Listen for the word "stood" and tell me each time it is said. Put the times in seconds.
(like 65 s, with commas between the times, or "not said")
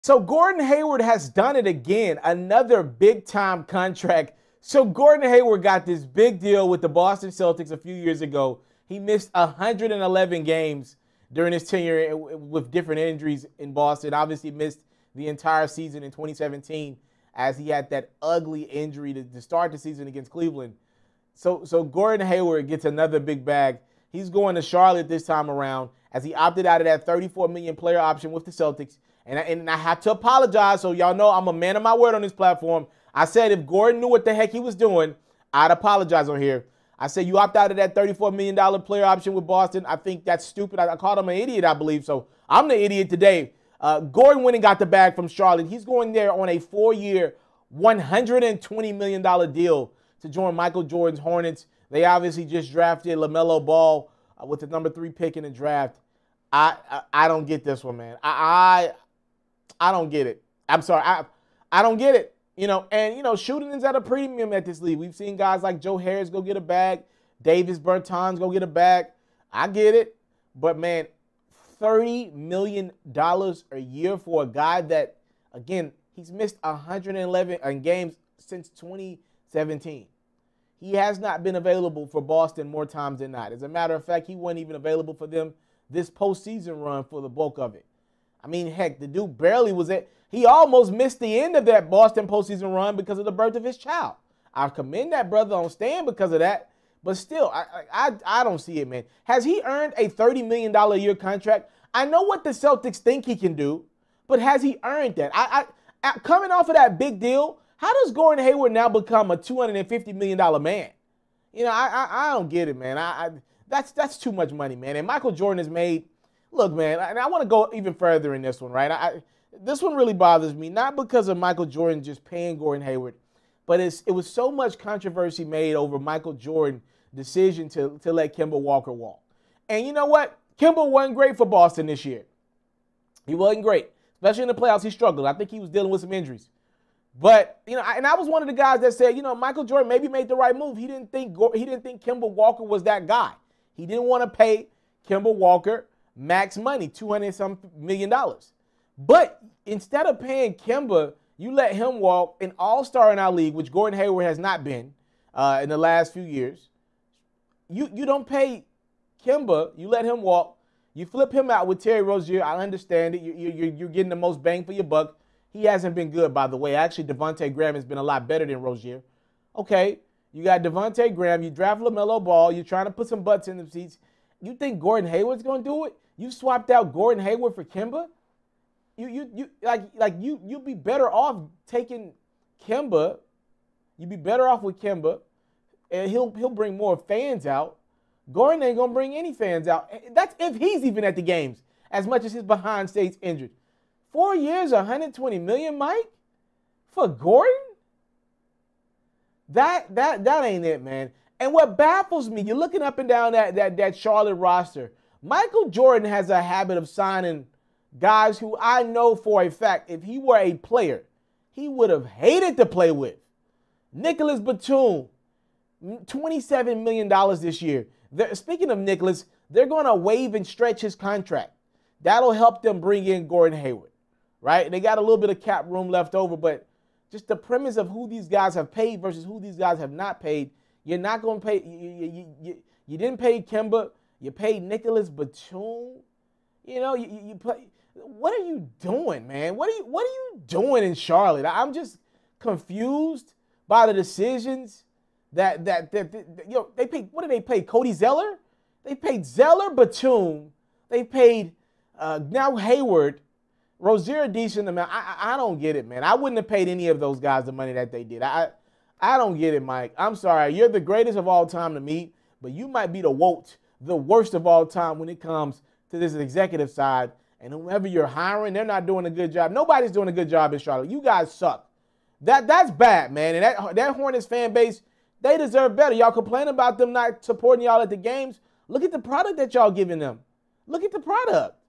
not said.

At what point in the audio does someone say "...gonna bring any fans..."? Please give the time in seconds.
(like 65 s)
188 s.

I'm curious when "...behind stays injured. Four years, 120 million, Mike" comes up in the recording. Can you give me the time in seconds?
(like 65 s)
192 s.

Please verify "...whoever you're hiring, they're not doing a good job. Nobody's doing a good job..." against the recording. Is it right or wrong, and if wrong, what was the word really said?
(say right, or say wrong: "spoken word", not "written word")
right.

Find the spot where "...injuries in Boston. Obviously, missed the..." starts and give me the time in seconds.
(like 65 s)
12 s.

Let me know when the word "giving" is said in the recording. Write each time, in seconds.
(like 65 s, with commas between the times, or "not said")
279 s.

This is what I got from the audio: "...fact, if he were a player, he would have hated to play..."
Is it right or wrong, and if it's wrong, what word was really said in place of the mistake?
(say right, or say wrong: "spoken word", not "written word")
right.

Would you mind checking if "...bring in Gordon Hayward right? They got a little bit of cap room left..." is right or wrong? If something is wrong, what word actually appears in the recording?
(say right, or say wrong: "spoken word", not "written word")
right.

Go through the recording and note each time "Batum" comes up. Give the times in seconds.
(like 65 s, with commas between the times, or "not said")
214 s, 235 s, 249 s.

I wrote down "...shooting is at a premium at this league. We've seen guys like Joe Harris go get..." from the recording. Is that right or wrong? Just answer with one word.
right.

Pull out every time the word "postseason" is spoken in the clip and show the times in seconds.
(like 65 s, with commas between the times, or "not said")
86 s, 92 s.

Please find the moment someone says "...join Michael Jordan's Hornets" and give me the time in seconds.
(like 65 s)
50 s.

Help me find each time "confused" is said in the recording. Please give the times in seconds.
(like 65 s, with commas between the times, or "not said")
242 s.